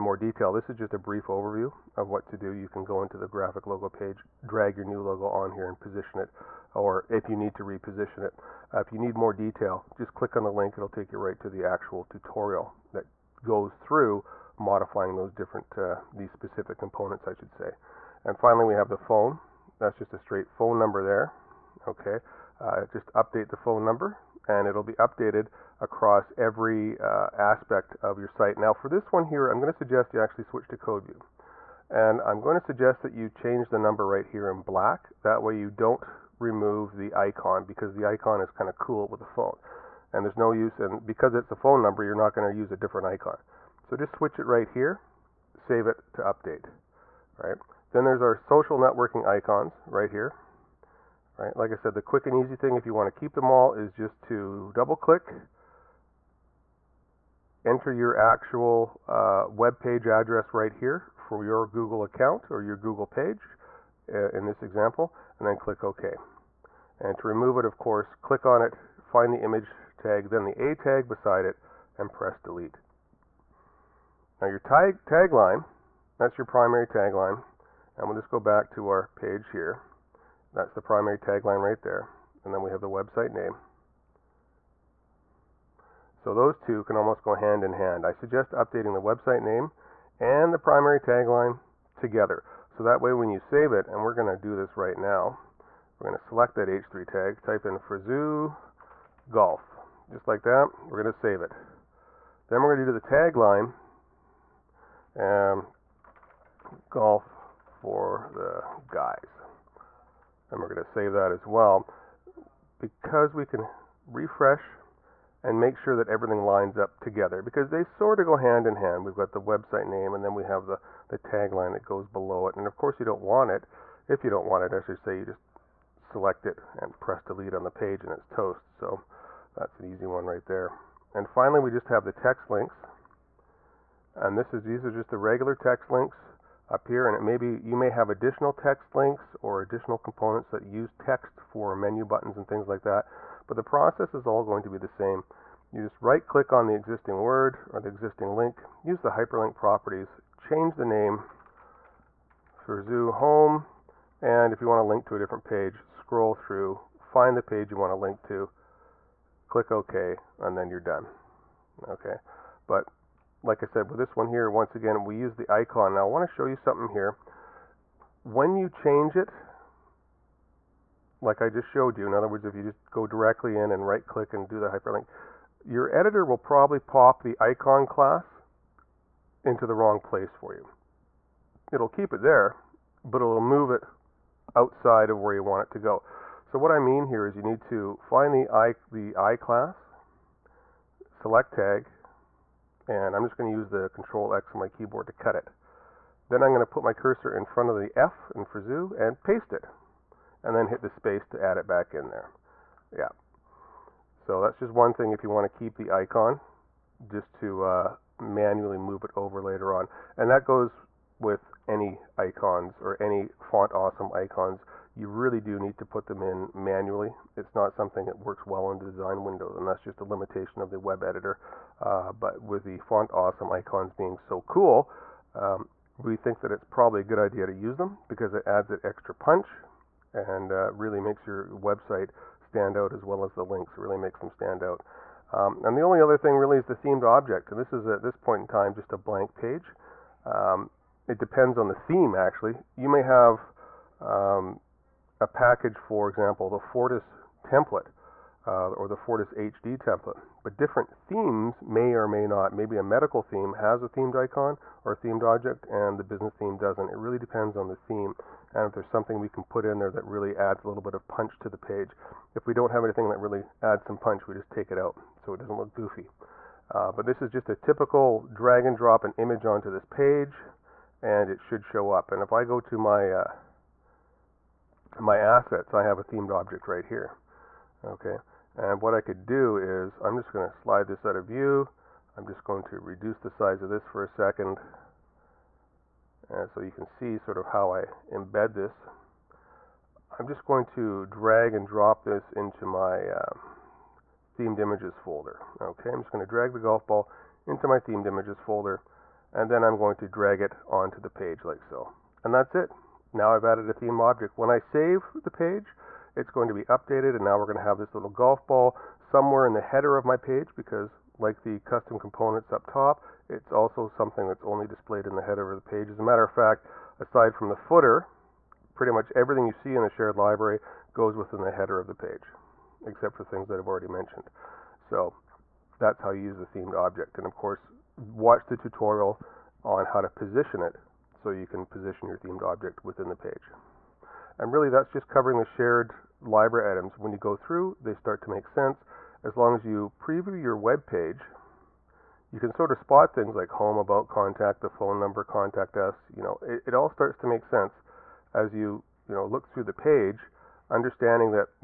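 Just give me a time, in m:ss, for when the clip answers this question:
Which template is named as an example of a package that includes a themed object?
4:06.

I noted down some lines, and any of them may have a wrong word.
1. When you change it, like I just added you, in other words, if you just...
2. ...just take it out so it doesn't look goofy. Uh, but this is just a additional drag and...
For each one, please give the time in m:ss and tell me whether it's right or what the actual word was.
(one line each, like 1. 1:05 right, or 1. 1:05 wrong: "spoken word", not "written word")
1. 2:48 wrong: "showed", not "added"
2. 4:24 wrong: "typical", not "additional".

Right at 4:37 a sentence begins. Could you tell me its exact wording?
Okay, and what I could do is I'm just going to slide this out of view.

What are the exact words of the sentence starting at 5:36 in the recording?
When you go through, they start to make sense.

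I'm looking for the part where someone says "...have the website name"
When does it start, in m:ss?
1:22.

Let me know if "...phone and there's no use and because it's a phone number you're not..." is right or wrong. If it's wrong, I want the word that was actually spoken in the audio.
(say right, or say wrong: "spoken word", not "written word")
right.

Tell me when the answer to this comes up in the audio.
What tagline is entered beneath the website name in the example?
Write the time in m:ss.
1:46.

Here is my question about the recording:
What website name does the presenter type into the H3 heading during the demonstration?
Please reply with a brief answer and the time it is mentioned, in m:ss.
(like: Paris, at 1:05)
Frazoo Golf, at 1:37.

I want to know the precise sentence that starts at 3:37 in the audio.
It's not something that works well in the design window, and that's just a limitation of the web editor.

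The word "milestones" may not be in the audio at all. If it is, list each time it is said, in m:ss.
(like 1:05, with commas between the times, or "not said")
not said.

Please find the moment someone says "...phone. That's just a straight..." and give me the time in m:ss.
0:18.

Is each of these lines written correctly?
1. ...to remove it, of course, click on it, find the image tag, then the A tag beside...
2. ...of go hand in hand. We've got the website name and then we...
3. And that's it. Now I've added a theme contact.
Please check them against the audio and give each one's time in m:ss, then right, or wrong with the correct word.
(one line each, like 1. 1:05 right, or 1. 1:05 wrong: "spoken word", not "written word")
1. 1:07 right
2. 1:58 right
3. 5:02 wrong: "object", not "contact".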